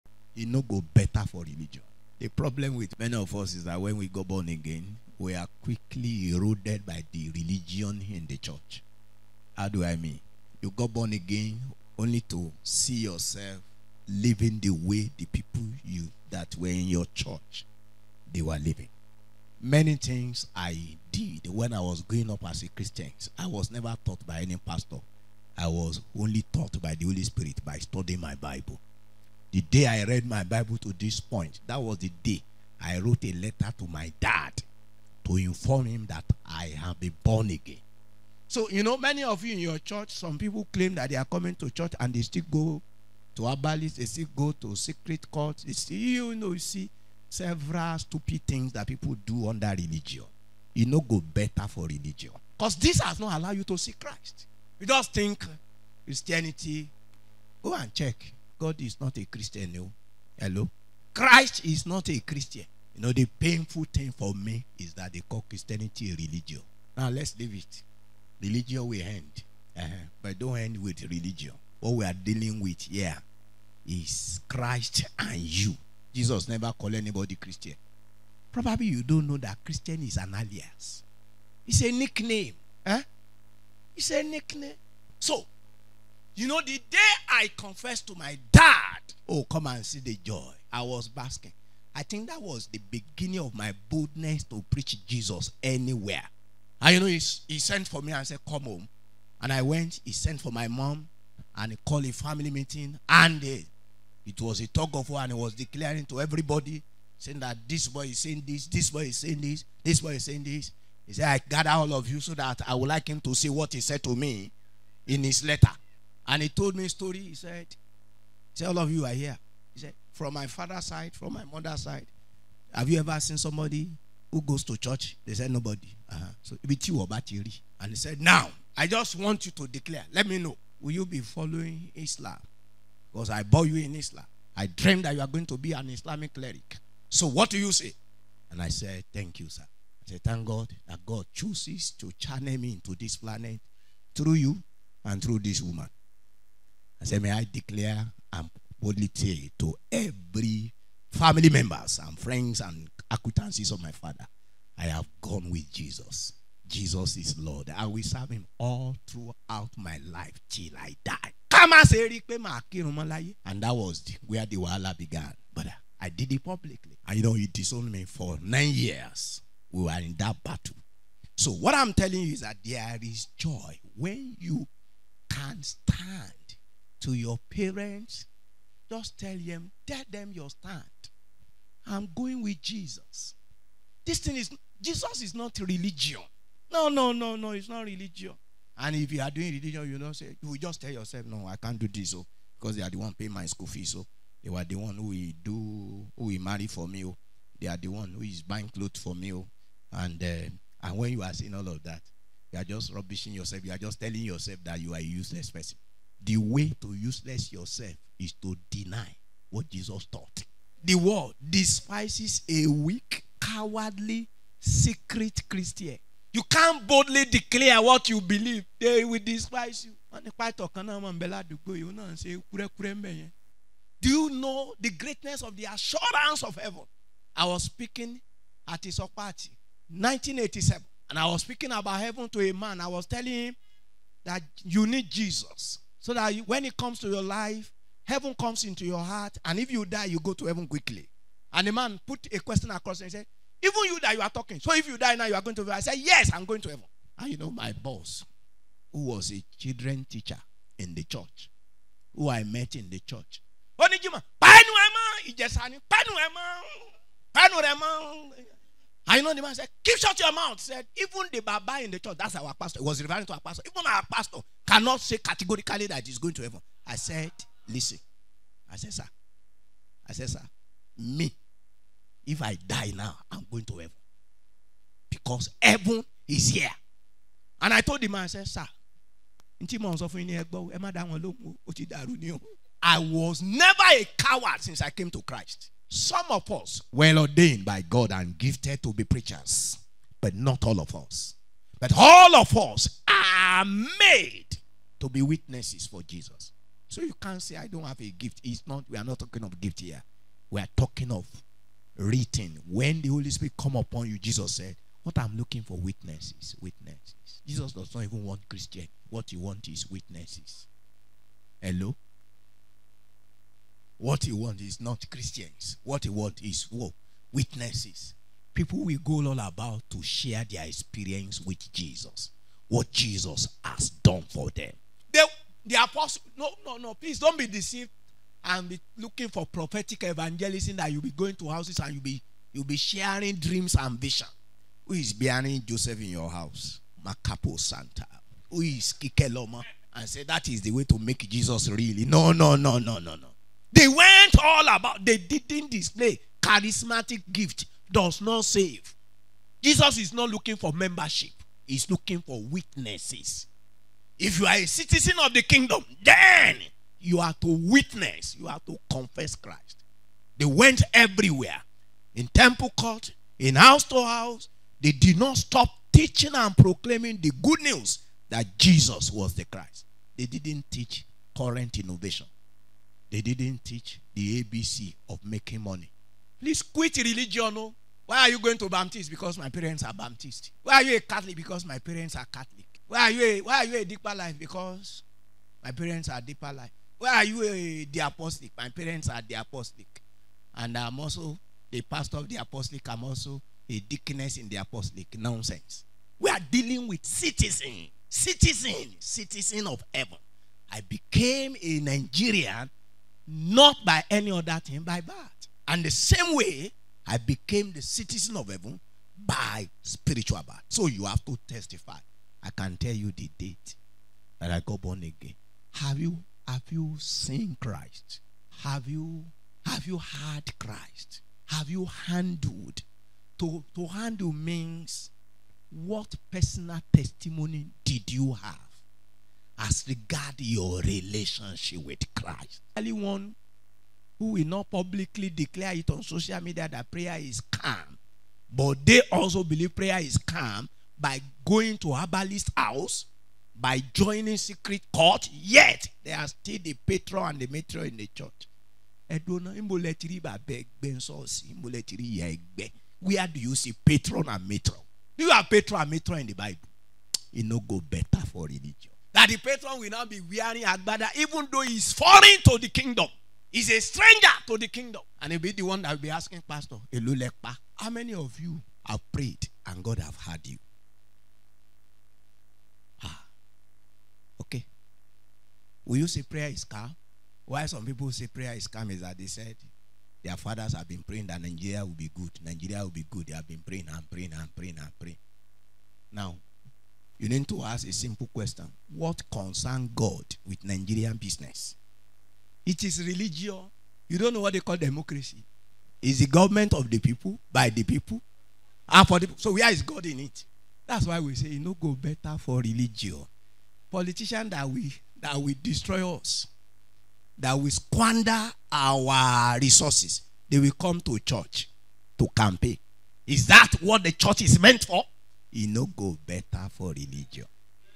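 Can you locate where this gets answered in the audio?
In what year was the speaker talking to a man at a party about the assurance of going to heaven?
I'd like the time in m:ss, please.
3:49.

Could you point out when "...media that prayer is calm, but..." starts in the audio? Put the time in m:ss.
7:16.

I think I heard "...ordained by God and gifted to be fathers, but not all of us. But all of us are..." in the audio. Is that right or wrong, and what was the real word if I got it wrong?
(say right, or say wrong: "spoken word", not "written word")
wrong: "preachers", not "fathers".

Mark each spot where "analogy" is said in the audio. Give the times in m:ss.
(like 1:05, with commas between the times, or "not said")
not said.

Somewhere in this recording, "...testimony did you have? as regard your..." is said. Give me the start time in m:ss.
7:06.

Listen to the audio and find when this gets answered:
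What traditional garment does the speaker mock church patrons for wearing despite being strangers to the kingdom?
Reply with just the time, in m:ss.
7:40.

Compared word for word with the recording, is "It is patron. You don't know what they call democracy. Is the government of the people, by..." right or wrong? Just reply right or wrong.
wrong.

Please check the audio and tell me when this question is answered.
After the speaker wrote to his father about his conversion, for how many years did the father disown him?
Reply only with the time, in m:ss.
2:48.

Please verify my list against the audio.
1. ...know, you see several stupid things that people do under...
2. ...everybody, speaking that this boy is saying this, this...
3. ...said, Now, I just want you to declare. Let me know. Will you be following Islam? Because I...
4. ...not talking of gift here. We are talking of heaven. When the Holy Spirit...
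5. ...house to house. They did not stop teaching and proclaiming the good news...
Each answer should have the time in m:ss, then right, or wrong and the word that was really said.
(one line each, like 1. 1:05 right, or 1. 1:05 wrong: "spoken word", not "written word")
1. 0:46 right
2. 1:46 wrong: "saying", not "speaking"
3. 2:07 right
4. 4:59 wrong: "written", not "heaven"
5. 6:03 right.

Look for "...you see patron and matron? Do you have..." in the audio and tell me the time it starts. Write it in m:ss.
7:33.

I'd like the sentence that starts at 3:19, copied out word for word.
and uh, and when you are saying all of that, you are just rubbishing yourself.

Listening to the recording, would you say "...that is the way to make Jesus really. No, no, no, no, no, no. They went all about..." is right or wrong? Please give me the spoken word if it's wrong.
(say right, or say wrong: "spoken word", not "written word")
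right.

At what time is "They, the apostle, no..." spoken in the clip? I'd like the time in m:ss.
5:25.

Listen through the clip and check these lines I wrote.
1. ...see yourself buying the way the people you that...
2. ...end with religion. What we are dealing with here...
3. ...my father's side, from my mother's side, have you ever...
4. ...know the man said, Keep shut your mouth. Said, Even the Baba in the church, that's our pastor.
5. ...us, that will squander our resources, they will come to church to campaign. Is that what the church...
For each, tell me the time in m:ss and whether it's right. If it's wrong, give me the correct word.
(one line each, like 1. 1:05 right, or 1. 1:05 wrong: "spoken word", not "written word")
1. 0:12 wrong: "living", not "buying"
2. 1:10 right
3. 2:00 right
4. 4:19 right
5. 8:26 right.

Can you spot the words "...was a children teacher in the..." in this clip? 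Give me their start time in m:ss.
4:09.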